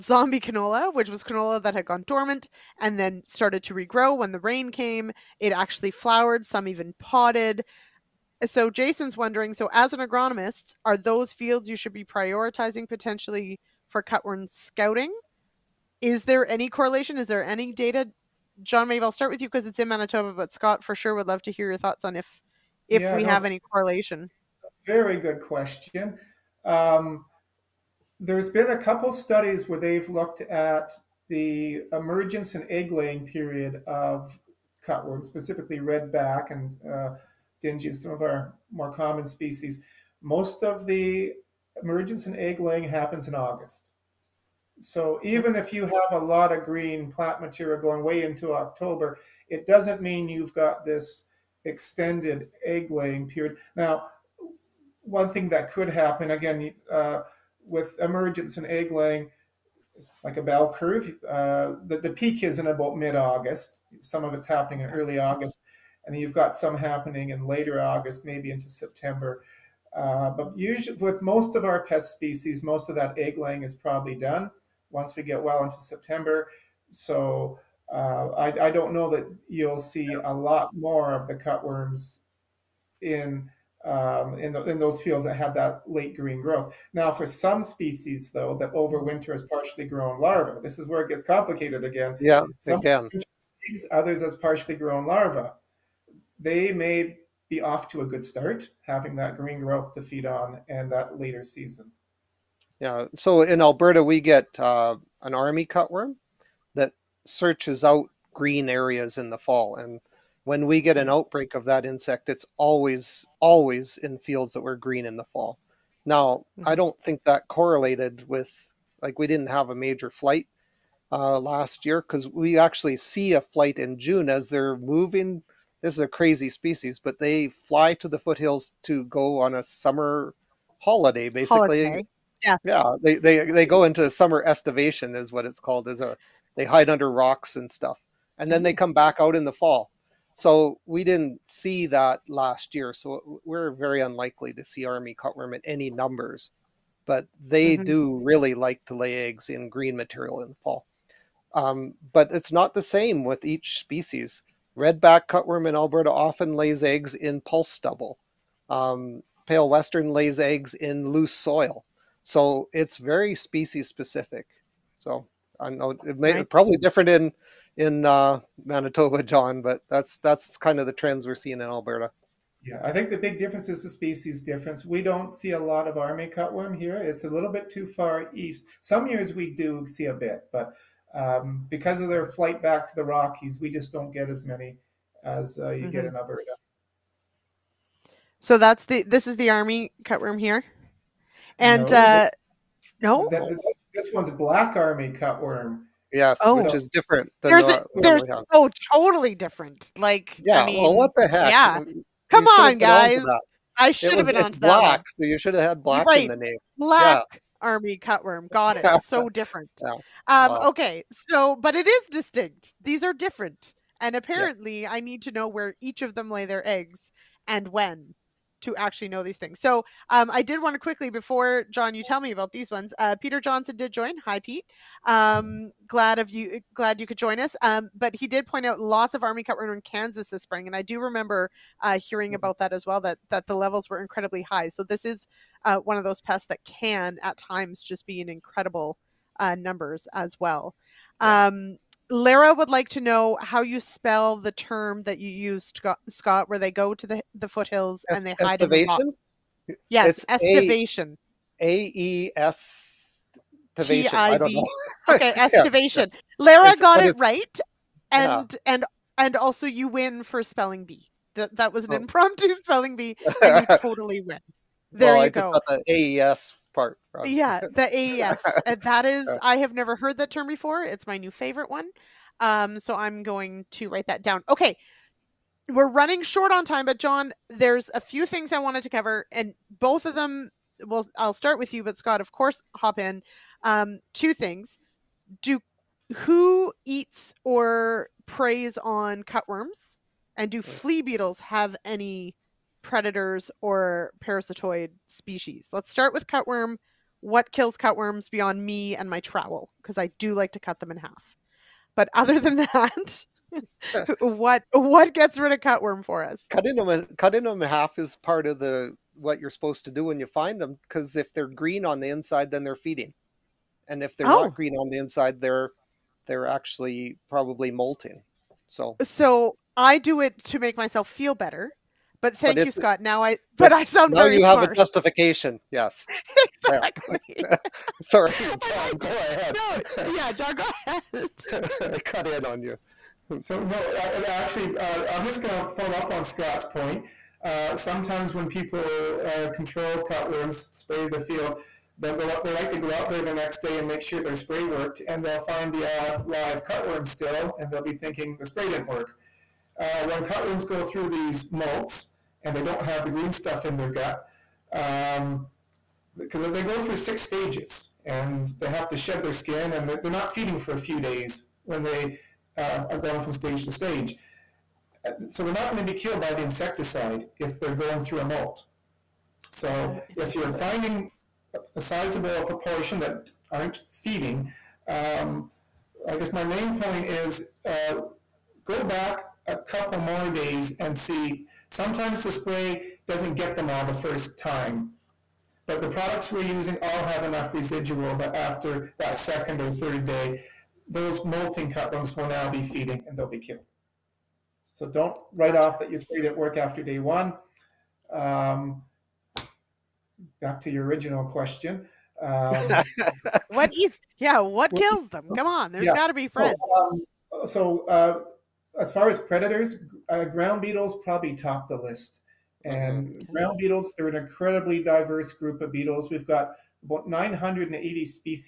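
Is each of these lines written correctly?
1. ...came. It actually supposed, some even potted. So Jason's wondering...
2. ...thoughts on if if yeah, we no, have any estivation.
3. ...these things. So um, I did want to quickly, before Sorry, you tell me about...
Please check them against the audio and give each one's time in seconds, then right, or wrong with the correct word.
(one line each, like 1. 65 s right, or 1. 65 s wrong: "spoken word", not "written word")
1. 4 s wrong: "flowered", not "supposed"
2. 21 s wrong: "correlation", not "estivation"
3. 219 s wrong: "John", not "Sorry".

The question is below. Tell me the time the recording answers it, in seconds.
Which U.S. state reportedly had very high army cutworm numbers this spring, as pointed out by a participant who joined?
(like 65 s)
228 s.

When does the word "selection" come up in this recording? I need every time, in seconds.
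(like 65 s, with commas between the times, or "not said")
not said.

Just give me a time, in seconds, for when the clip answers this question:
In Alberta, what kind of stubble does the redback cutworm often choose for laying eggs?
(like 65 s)
154 s.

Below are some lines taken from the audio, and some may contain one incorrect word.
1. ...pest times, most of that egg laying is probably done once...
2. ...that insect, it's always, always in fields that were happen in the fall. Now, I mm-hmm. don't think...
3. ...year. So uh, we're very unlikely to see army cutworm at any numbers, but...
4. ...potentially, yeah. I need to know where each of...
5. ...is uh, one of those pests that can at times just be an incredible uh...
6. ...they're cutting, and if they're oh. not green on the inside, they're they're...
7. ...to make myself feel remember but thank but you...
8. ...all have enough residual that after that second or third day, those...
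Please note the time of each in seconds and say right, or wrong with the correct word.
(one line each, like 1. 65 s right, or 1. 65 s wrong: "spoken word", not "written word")
1. 71 s wrong: "species", not "times"
2. 111 s wrong: "green", not "happen"
3. 142 s right
4. 214 s wrong: "apparently", not "potentially"
5. 235 s right
6. 312 s wrong: "feeding", not "cutting"
7. 320 s wrong: "better", not "remember"
8. 386 s right.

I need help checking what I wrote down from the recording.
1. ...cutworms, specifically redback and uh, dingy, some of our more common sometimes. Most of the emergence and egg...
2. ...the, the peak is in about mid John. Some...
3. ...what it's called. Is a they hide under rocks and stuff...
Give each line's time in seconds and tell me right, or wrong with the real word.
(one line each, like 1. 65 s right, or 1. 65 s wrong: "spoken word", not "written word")
1. 34 s wrong: "species", not "sometimes"
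2. 61 s wrong: "August", not "John"
3. 135 s right.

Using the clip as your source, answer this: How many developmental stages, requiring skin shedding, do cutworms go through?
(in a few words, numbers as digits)
6.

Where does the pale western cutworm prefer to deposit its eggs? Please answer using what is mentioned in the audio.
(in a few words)
Loose soil.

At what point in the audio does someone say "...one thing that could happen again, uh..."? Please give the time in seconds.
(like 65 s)
55 s.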